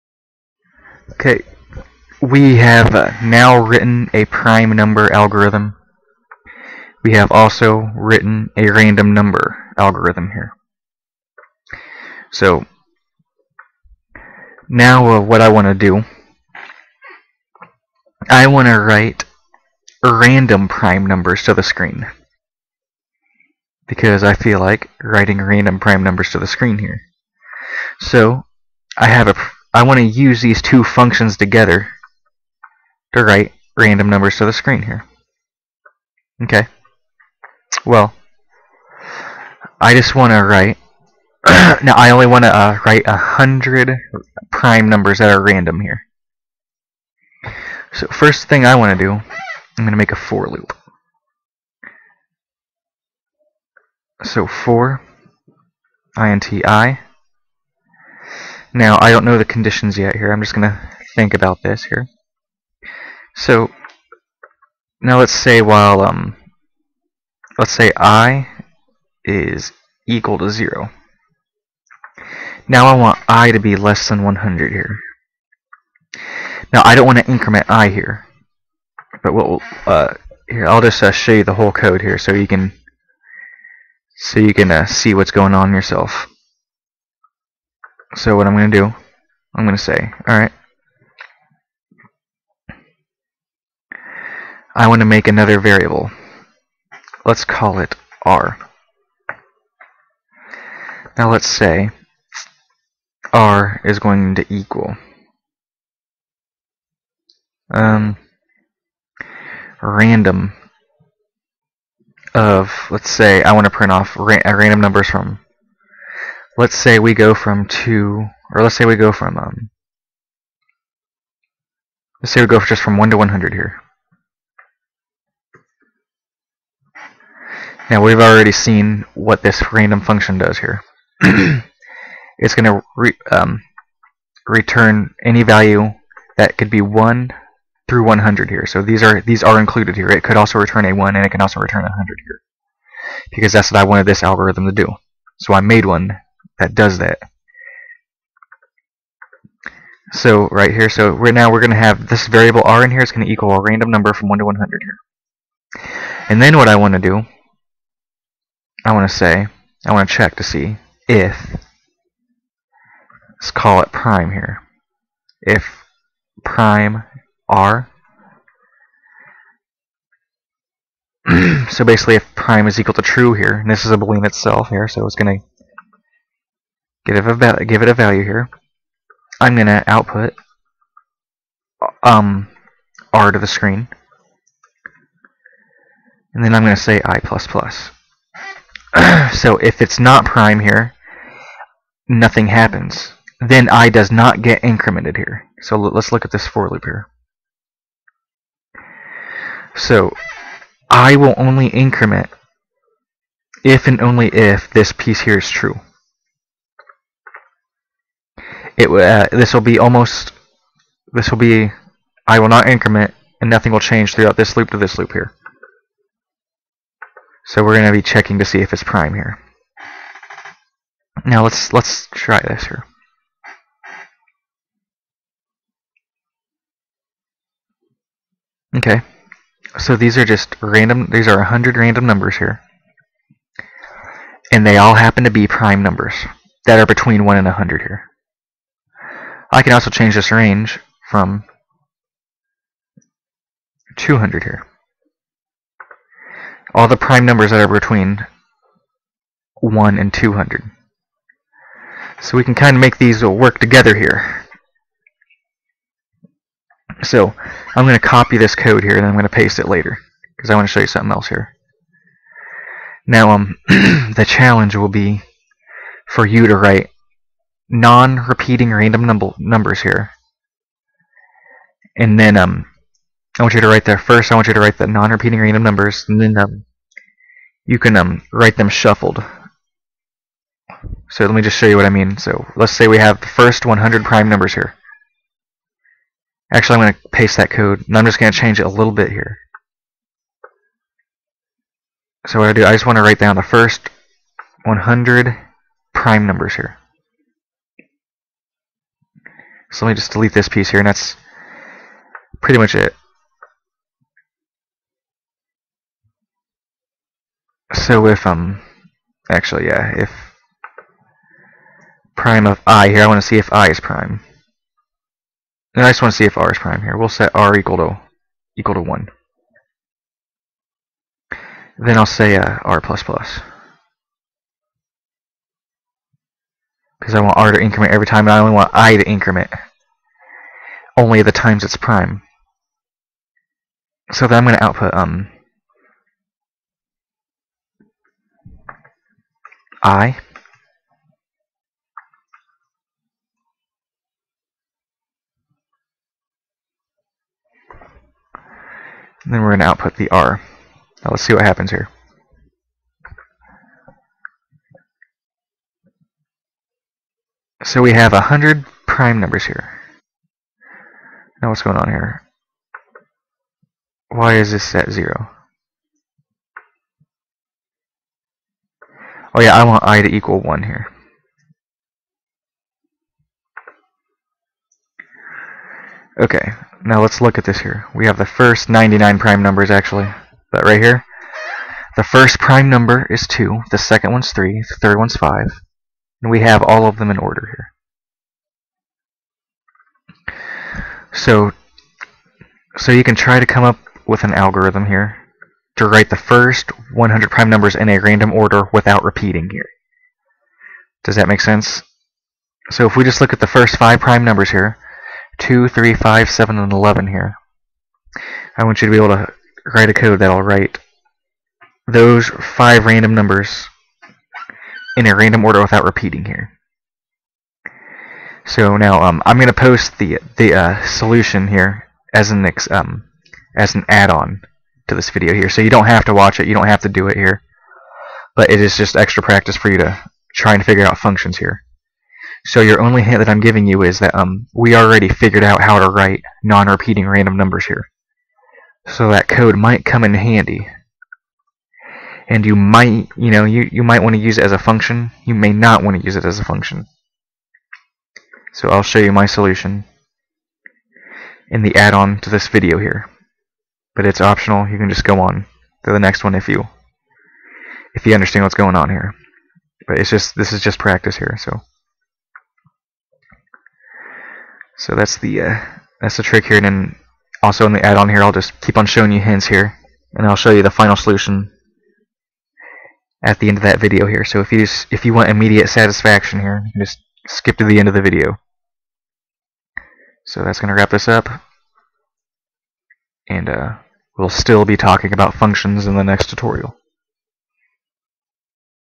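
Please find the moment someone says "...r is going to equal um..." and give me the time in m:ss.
1:43.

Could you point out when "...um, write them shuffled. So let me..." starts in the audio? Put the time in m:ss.
4:37.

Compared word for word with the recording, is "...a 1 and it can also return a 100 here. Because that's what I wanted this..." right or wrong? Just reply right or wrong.
right.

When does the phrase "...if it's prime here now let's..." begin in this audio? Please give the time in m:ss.
3:38.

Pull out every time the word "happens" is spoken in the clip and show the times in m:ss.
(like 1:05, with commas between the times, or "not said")
3:12, 3:54, 5:51.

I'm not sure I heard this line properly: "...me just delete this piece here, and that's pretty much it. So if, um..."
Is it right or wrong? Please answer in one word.
right.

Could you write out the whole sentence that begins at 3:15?
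So let's look at this for loop here.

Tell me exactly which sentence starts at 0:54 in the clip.
So for inti now, I don't know the conditions yet here.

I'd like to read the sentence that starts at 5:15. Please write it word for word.
And I just want to see if r is prime here.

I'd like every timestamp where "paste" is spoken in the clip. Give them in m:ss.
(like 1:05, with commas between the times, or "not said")
4:19, 4:47.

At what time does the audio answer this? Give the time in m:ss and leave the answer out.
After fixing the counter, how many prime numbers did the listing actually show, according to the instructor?
6:18.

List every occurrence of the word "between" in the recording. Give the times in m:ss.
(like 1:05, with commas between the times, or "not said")
3:56, 4:07.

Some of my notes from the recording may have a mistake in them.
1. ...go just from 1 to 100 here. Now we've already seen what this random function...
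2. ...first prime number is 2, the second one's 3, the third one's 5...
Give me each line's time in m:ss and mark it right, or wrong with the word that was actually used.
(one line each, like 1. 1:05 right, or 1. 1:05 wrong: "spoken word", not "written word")
1. 2:02 right
2. 6:22 right.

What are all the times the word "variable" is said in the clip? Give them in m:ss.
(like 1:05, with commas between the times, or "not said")
1:35, 2:32.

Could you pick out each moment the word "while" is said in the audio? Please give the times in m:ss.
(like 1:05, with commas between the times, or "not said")
1:05.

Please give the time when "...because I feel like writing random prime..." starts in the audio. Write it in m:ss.
0:23.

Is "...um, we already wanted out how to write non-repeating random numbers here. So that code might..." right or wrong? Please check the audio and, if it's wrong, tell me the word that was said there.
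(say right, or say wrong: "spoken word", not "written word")
wrong: "figured", not "wanted".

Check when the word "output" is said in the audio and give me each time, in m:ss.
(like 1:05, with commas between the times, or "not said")
2:59, 5:34, 5:49.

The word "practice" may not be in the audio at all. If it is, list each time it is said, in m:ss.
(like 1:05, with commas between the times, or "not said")
7:09, 7:40.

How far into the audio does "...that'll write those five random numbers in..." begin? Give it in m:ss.
6:50.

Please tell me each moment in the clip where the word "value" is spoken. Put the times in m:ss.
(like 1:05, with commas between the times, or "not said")
2:15, 2:57.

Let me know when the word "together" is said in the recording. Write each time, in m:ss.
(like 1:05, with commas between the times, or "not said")
0:31, 4:13.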